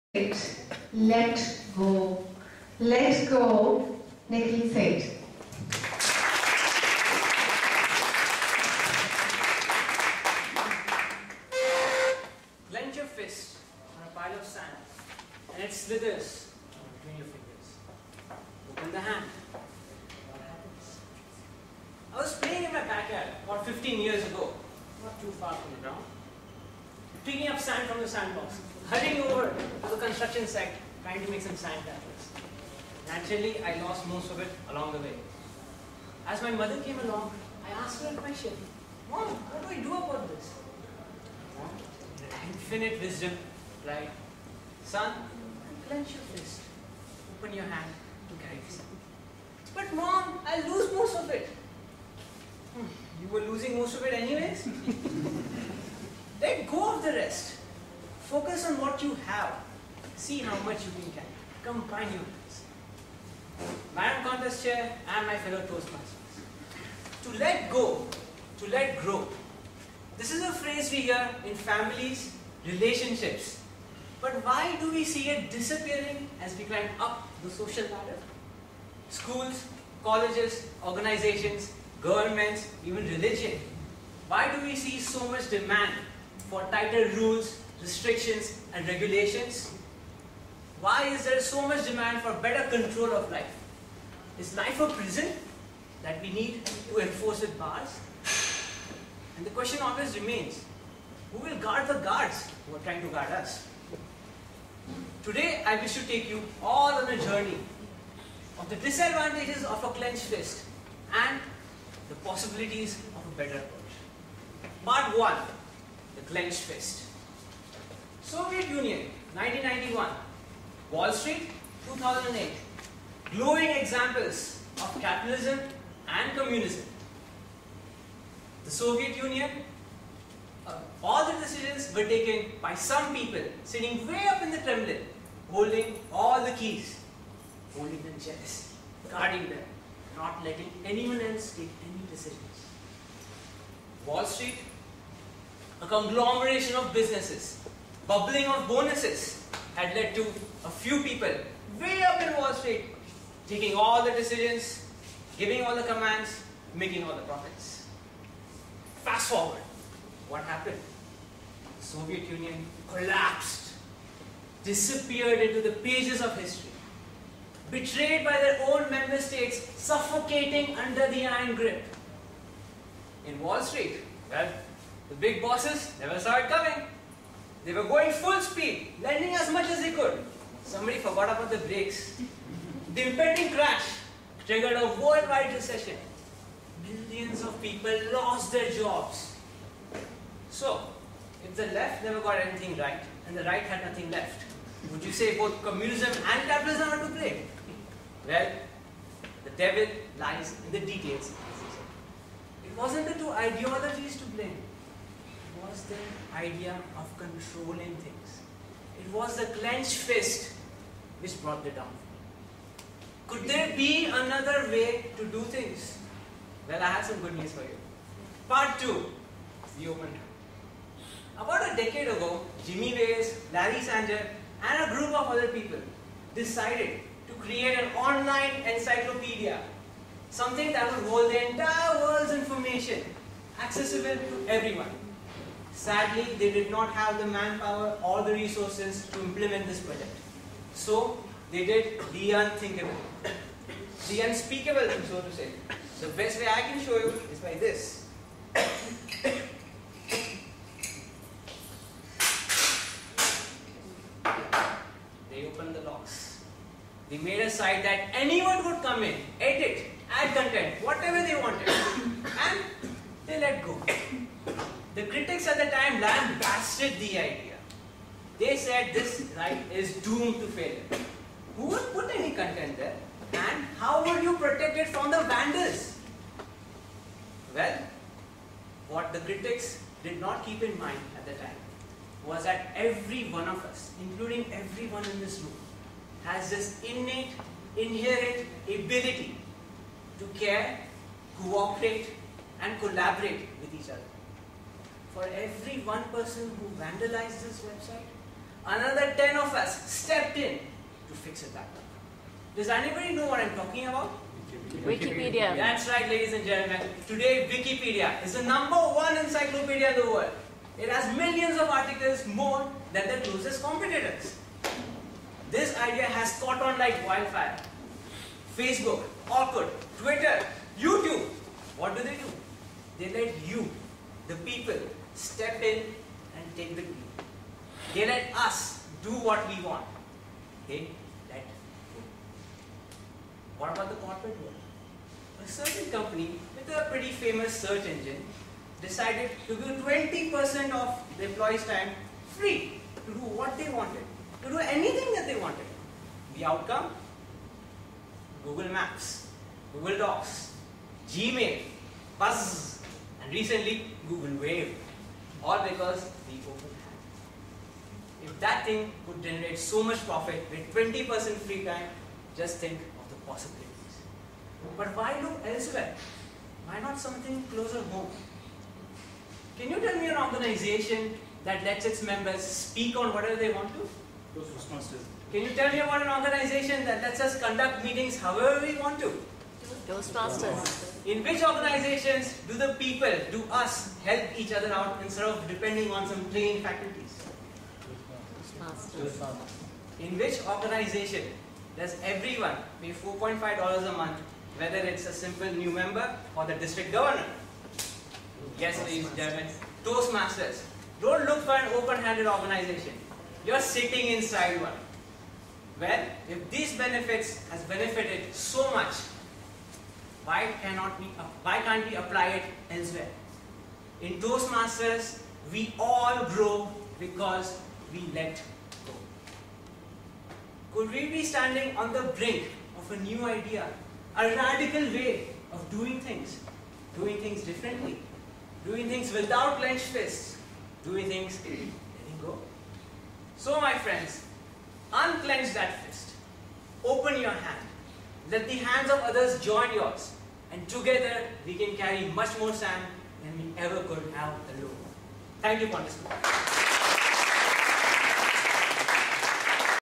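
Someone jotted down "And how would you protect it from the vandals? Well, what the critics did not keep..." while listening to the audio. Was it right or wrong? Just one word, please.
right.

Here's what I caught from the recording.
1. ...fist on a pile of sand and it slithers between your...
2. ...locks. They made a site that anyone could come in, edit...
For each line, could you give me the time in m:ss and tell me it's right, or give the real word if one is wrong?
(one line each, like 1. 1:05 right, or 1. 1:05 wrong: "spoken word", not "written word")
1. 0:13 right
2. 4:15 right.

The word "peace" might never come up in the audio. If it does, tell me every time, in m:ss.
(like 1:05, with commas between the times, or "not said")
not said.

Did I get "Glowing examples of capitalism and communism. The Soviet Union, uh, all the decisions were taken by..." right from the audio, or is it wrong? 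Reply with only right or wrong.
right.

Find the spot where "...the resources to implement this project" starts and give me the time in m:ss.
3:58.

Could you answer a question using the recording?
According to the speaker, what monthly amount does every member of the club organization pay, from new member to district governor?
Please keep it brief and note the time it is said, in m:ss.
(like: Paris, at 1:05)
$4.5, at 6:32.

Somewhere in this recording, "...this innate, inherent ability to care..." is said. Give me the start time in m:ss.
4:46.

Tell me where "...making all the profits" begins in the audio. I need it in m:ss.
2:36.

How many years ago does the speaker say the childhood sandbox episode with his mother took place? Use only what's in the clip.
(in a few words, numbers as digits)
15.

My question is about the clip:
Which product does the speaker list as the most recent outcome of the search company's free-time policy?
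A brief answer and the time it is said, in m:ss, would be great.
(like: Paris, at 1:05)
Google Wave, at 5:54.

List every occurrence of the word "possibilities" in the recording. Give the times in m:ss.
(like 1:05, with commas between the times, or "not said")
1:52, 6:03.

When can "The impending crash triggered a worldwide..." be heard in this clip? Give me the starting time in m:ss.
3:02.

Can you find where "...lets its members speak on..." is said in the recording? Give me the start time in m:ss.
6:11.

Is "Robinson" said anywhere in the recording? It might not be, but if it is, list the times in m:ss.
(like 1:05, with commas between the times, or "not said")
not said.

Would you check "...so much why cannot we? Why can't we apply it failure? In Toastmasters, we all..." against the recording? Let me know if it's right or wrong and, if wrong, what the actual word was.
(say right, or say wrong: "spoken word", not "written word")
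wrong: "elsewhere", not "failure".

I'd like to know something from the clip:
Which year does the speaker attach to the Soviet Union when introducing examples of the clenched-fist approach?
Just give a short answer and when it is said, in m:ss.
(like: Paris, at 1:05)
1991, at 1:59.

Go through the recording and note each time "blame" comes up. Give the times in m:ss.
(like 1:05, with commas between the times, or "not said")
3:17, 3:24.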